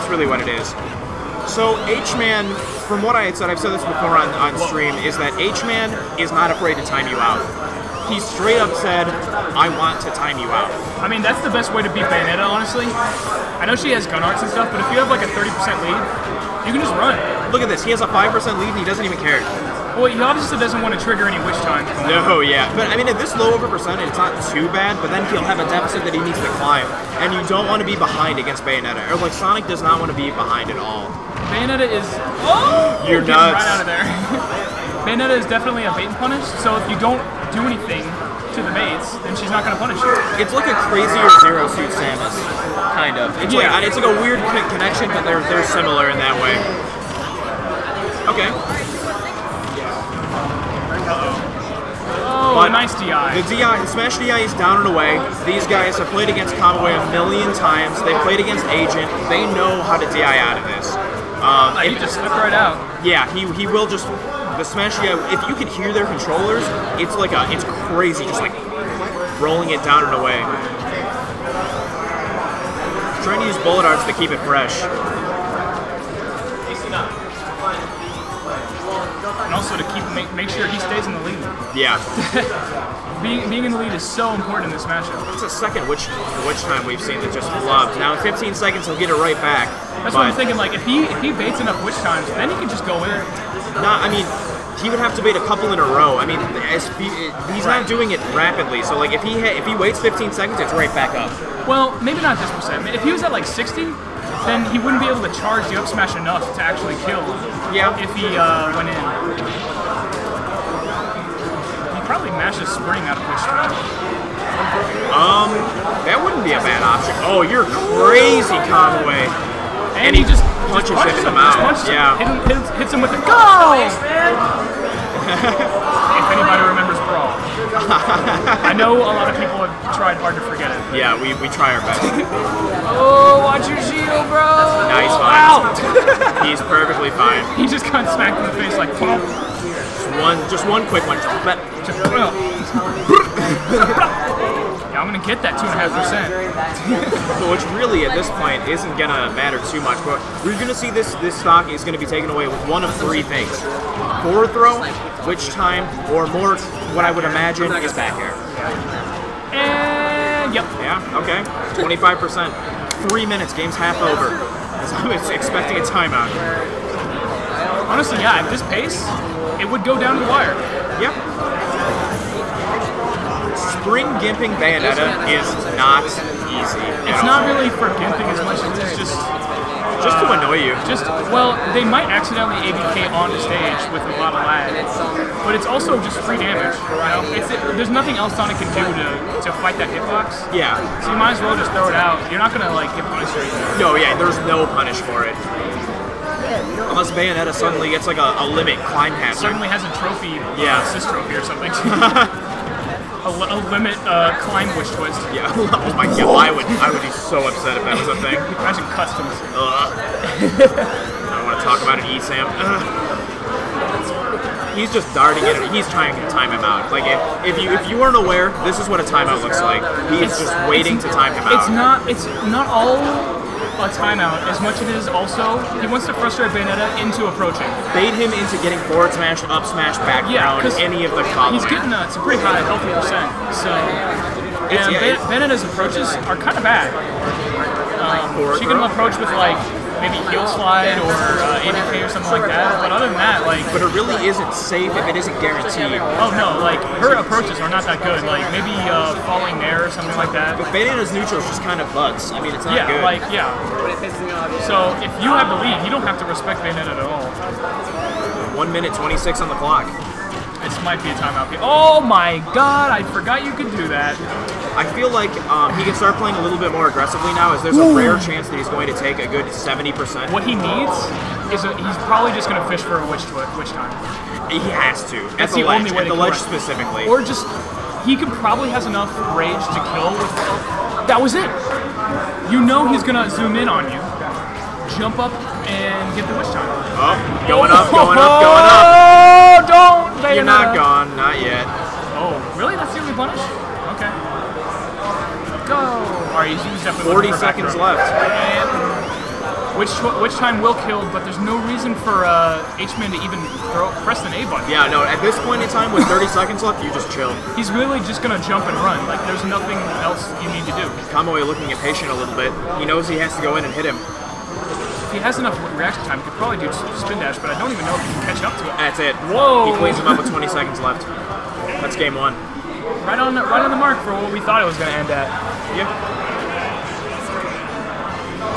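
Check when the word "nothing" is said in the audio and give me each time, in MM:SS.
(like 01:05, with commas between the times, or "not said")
03:07, 05:09.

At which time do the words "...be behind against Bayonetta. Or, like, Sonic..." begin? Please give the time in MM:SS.
00:27.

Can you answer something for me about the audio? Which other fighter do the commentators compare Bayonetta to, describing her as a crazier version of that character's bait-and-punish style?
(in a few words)
Zero Suit Samus.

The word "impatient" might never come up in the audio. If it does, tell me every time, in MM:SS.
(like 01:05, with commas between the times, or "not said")
05:11.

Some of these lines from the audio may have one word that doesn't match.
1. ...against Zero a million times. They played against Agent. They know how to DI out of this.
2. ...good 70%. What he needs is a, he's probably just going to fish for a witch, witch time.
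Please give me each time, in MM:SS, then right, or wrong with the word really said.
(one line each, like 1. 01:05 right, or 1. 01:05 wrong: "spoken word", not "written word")
1. 00:56 wrong: "Conway", not "Zero"
2. 04:29 right.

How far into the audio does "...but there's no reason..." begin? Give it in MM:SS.
05:01.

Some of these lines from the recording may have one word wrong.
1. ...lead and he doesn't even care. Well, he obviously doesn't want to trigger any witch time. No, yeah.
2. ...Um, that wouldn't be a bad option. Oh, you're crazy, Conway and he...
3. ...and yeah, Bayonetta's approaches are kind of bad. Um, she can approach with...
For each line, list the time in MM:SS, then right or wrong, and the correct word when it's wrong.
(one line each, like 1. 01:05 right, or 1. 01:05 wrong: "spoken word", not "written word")
1. 00:18 right
2. 01:55 right
3. 03:54 right.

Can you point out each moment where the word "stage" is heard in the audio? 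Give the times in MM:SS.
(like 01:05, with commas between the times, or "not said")
03:03.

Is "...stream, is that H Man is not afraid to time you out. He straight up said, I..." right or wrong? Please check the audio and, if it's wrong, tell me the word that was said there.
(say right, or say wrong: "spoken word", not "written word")
right.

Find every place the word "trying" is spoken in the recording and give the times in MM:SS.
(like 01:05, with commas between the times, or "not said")
01:13, 03:35.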